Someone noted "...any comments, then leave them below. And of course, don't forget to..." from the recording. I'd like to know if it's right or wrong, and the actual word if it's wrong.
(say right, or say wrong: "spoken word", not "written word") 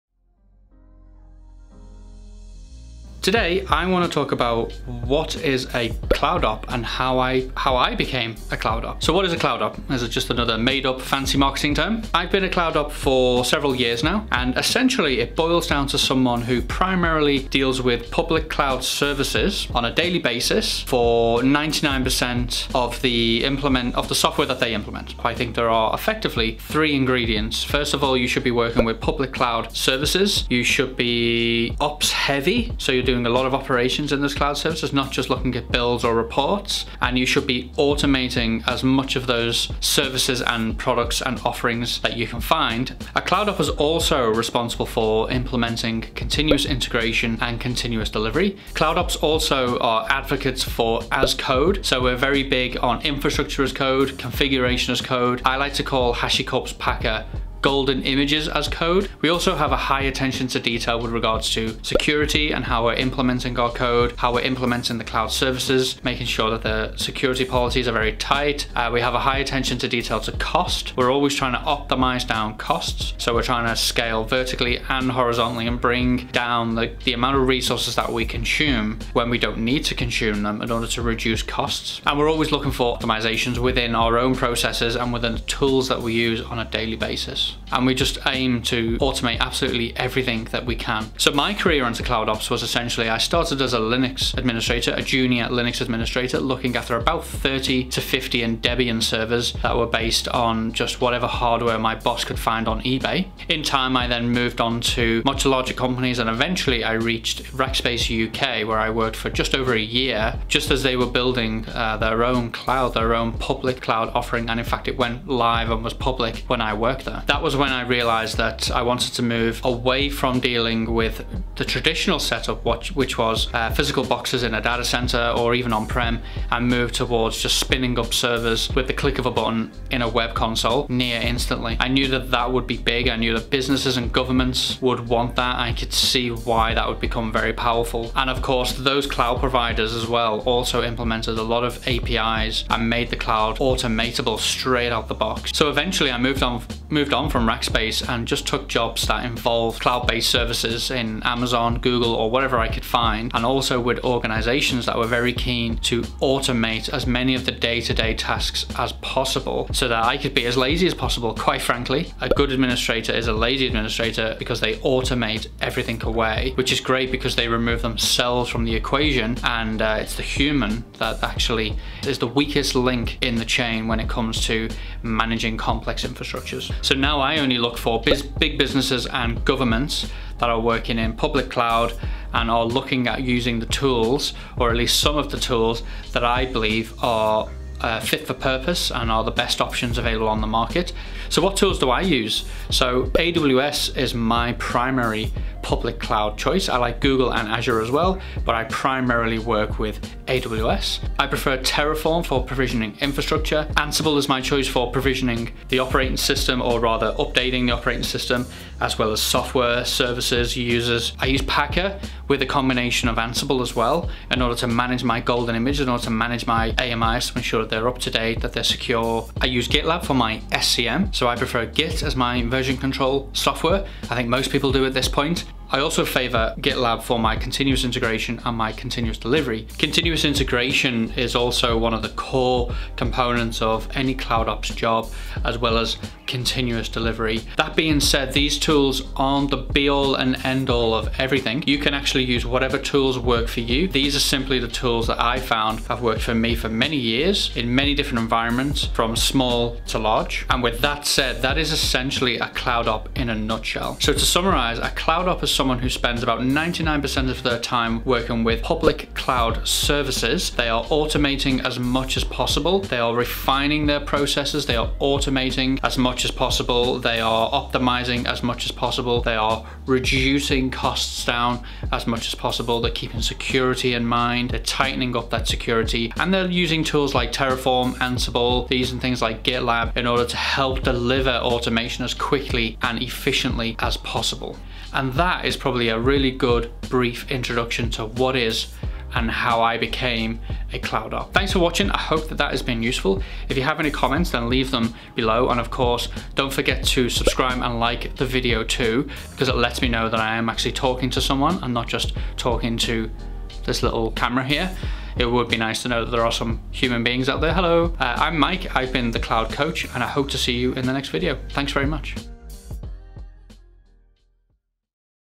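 right.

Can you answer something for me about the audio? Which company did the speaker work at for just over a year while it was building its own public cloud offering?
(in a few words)
Rackspace UK.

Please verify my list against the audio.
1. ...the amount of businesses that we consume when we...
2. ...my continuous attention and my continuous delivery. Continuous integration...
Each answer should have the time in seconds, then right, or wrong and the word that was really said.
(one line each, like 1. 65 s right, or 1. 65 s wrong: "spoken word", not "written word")
1. 77 s wrong: "resources", not "businesses"
2. 227 s wrong: "integration", not "attention".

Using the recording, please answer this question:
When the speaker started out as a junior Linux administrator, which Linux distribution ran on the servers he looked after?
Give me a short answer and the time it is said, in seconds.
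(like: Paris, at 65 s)
Debian, at 98 s.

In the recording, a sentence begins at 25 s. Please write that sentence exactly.
I think there are effectively three ingredients.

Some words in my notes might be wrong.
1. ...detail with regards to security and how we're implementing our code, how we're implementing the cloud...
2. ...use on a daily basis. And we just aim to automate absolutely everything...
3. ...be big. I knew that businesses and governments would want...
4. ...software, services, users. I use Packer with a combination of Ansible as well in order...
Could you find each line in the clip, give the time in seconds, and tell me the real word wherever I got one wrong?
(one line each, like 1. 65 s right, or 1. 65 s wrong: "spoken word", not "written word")
1. 60 s right
2. 86 s right
3. 132 s right
4. 209 s right.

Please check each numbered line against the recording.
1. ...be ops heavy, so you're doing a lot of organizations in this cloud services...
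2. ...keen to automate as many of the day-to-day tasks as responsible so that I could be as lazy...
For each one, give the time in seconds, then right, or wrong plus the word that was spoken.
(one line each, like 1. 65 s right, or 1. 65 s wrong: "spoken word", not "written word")
1. 30 s wrong: "operations", not "organizations"
2. 155 s wrong: "possible", not "responsible".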